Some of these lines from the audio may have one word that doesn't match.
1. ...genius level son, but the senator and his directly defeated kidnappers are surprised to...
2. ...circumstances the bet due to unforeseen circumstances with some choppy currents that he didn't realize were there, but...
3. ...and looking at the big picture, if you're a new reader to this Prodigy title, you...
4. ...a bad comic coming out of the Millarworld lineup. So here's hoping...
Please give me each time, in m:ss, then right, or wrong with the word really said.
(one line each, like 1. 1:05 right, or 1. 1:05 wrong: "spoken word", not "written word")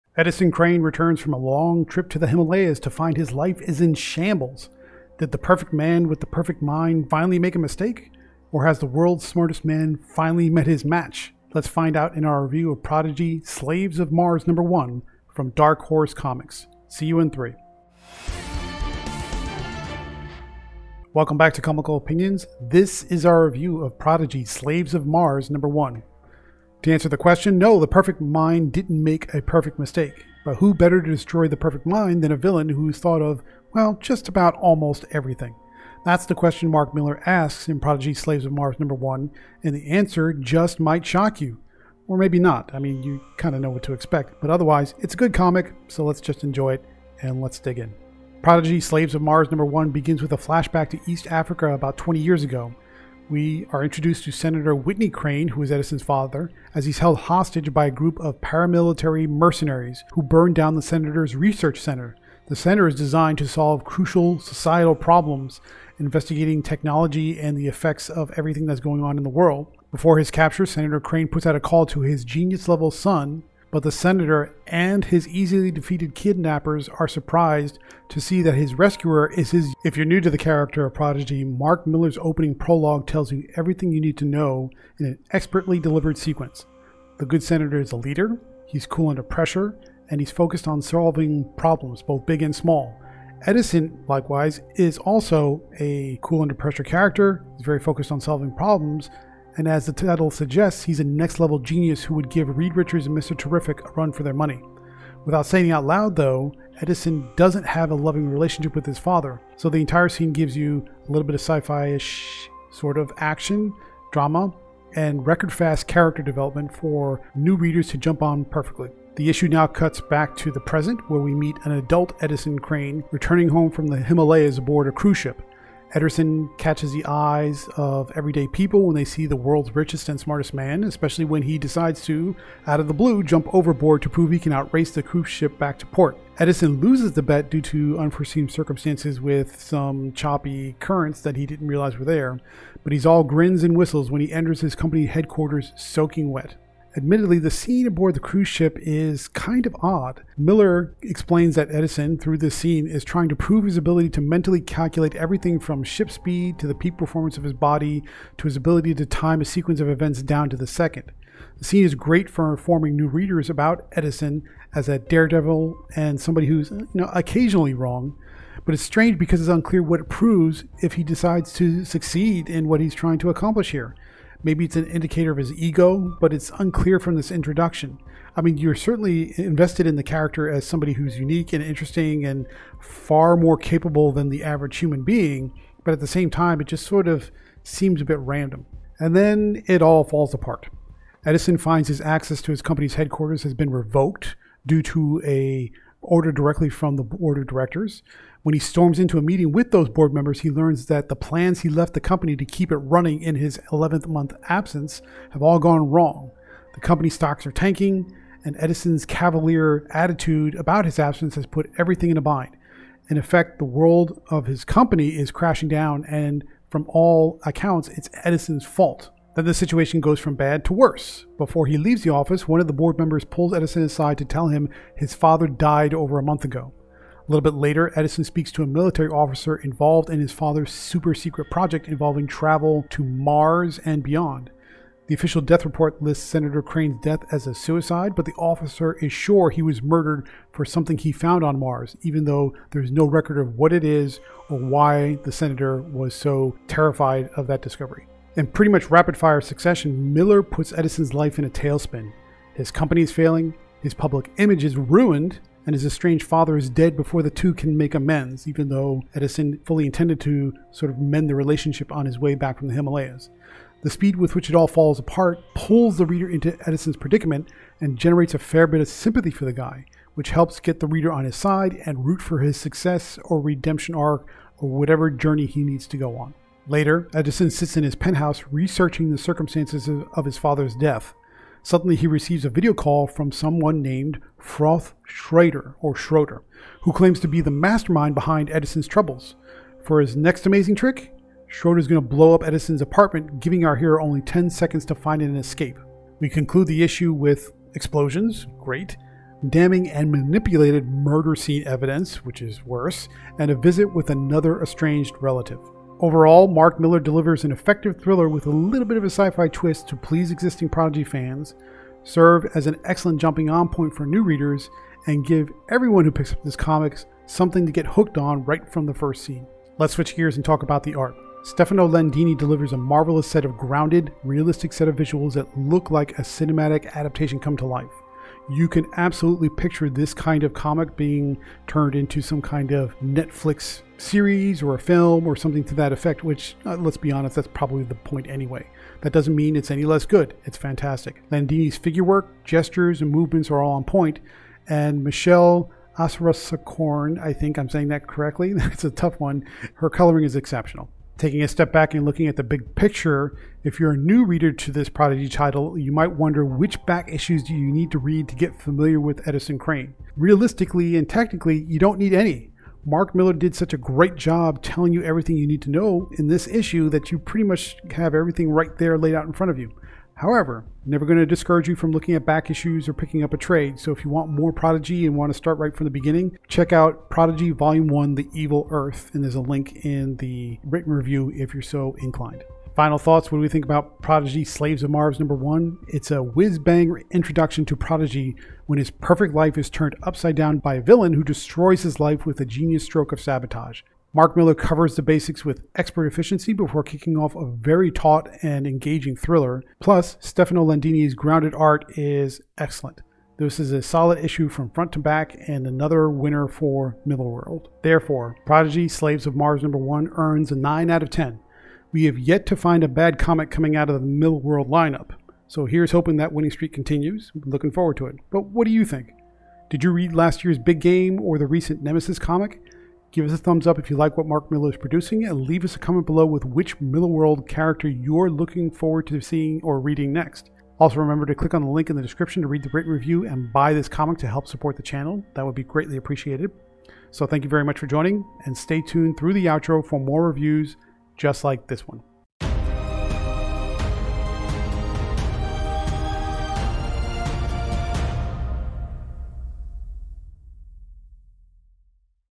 1. 1:12 wrong: "easily", not "directly"
2. 2:16 wrong: "loses", not "circumstances"
3. 5:51 right
4. 6:52 right.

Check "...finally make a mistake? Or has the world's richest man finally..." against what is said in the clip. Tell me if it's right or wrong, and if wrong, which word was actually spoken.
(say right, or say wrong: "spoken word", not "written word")
wrong: "smartest", not "richest".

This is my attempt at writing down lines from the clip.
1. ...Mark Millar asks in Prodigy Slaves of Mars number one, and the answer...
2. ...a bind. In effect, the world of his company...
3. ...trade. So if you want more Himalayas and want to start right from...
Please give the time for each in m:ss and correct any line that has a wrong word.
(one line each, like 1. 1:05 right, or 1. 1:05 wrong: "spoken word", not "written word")
1. 0:36 right
2. 3:32 right
3. 6:13 wrong: "Prodigy", not "Himalayas".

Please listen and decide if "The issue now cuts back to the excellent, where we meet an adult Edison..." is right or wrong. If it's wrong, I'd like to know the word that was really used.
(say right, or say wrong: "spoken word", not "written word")
wrong: "present", not "excellent".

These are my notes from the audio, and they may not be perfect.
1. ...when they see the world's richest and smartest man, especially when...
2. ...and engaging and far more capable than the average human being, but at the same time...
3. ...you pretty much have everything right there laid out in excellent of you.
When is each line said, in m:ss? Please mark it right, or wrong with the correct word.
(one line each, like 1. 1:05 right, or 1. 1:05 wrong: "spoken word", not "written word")
1. 2:08 right
2. 3:01 wrong: "interesting", not "engaging"
3. 6:07 wrong: "front", not "excellent".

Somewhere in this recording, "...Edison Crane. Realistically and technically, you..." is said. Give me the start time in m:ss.
5:59.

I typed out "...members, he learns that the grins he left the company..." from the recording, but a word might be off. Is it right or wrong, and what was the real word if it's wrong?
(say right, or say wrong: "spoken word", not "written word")
wrong: "plans", not "grins".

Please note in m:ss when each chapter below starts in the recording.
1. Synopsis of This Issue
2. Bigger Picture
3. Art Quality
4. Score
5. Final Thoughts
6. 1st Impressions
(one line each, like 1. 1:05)
1. 0:48
2. 5:50
3. 5:19
4. 6:49
5. 6:22
6. 0:21.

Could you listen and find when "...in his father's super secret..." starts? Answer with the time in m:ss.
3:50.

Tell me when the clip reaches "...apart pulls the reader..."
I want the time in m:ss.
4:24.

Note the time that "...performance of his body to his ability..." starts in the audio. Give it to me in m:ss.
2:36.